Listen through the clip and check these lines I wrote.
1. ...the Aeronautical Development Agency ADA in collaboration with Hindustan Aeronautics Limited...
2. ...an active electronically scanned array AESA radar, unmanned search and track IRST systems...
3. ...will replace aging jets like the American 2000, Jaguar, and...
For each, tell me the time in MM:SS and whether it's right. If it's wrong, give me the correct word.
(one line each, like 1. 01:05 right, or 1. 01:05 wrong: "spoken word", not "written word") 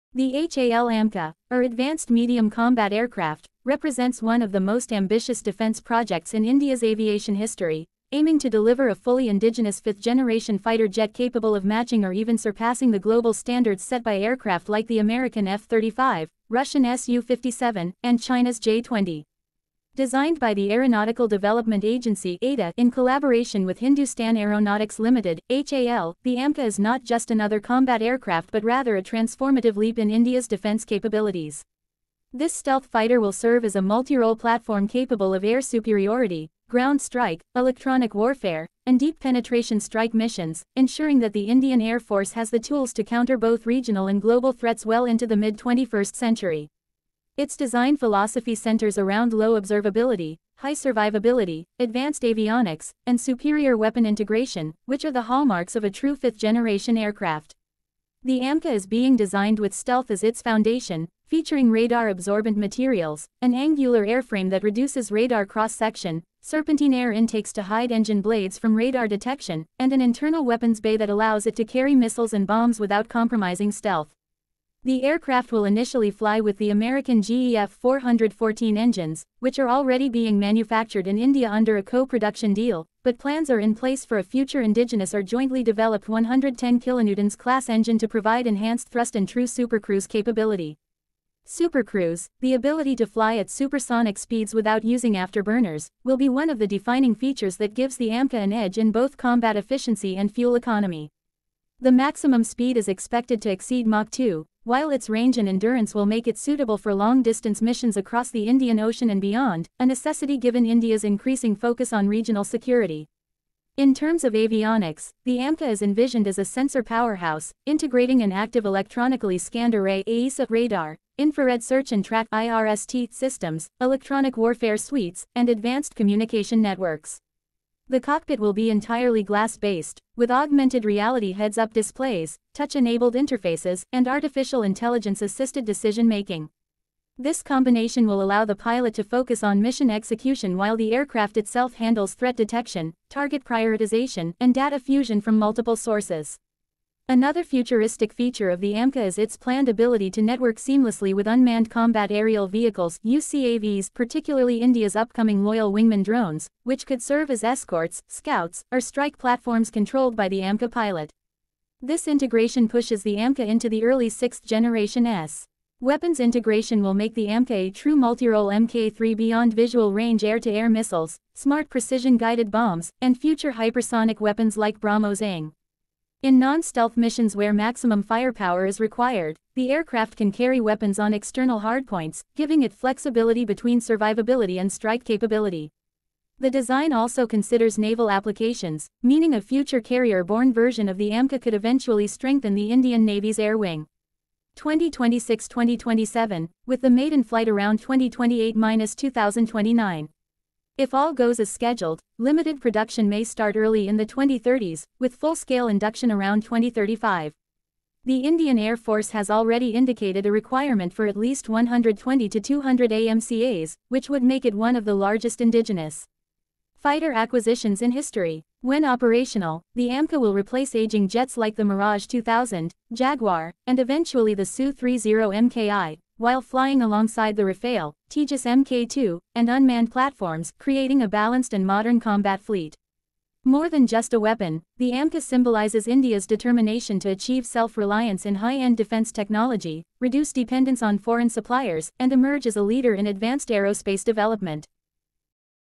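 1. 00:20 right
2. 01:58 wrong: "infrared", not "unmanned"
3. 03:40 wrong: "Mirage", not "American".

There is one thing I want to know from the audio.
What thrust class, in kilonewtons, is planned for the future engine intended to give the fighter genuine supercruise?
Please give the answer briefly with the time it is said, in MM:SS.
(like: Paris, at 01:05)
110 kilonewtons, at 01:26.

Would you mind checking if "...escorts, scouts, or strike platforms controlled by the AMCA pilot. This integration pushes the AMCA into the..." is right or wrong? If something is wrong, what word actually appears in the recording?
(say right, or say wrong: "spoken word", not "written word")
right.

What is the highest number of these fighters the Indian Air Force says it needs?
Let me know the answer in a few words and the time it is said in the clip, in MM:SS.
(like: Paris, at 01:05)
200, at 03:32.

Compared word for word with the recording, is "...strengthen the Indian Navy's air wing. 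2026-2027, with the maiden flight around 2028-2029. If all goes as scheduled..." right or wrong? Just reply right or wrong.
right.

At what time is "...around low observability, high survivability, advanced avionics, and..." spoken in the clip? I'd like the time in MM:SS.
00:48.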